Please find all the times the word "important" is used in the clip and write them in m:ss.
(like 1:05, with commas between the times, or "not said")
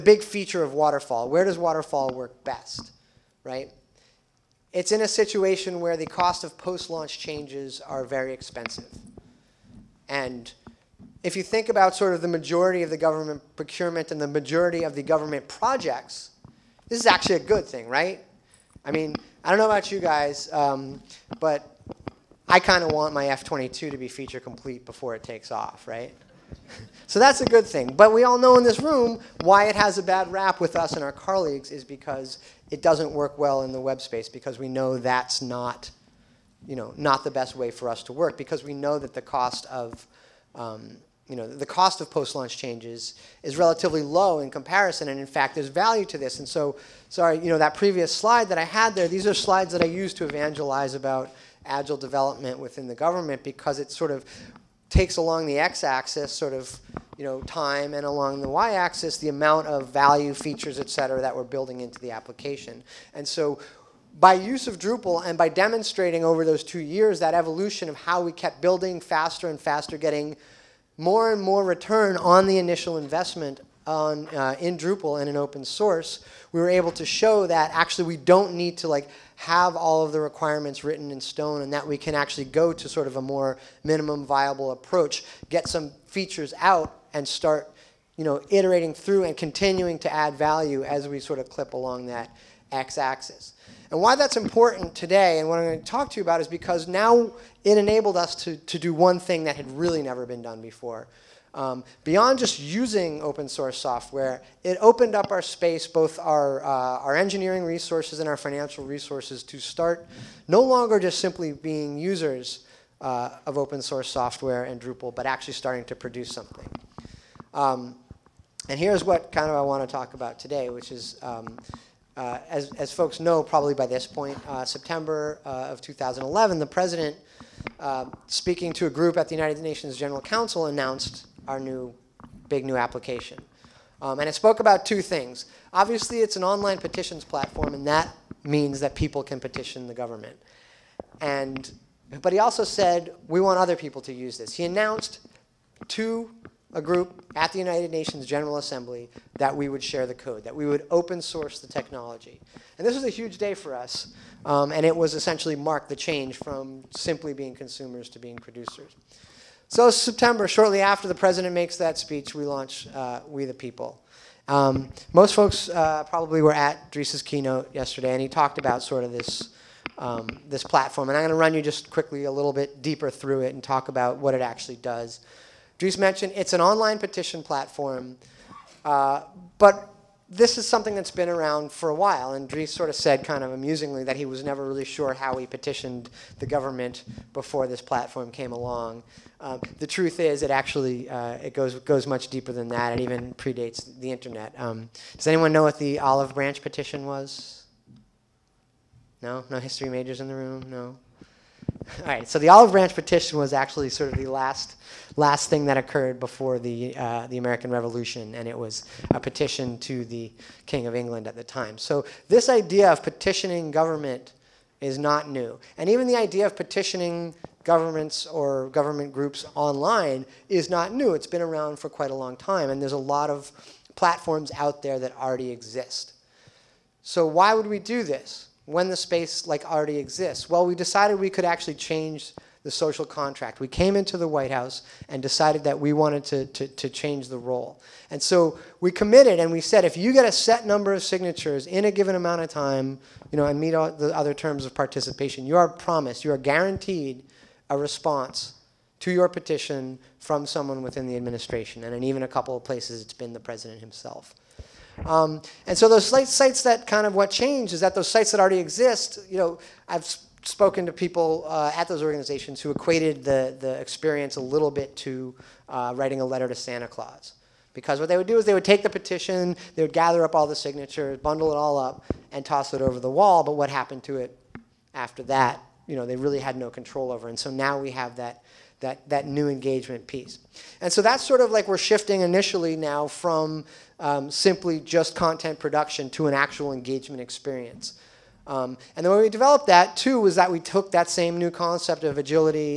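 1:34.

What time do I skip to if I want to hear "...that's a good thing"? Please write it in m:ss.
0:27.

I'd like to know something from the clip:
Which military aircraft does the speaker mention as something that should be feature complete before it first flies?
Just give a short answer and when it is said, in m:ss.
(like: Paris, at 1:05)
F-22, at 0:23.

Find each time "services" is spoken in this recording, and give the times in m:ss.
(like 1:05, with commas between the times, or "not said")
not said.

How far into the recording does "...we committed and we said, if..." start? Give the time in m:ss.
3:58.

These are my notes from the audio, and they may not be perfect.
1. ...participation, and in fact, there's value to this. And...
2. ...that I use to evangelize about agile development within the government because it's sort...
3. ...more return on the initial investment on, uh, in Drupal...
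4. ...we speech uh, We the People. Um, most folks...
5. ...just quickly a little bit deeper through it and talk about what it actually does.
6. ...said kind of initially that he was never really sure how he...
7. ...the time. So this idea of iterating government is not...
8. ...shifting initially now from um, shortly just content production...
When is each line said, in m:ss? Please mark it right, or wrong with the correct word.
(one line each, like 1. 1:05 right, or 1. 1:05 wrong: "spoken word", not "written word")
1. 0:44 wrong: "comparison", not "participation"
2. 0:49 right
3. 1:11 right
4. 2:42 wrong: "launch", not "speech"
5. 2:51 right
6. 3:02 wrong: "amusingly", not "initially"
7. 3:31 wrong: "petitioning", not "iterating"
8. 4:41 wrong: "simply", not "shortly".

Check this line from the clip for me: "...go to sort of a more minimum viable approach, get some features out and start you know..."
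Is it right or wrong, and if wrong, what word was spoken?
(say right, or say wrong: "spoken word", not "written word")
right.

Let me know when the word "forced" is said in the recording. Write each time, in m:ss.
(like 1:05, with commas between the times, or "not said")
not said.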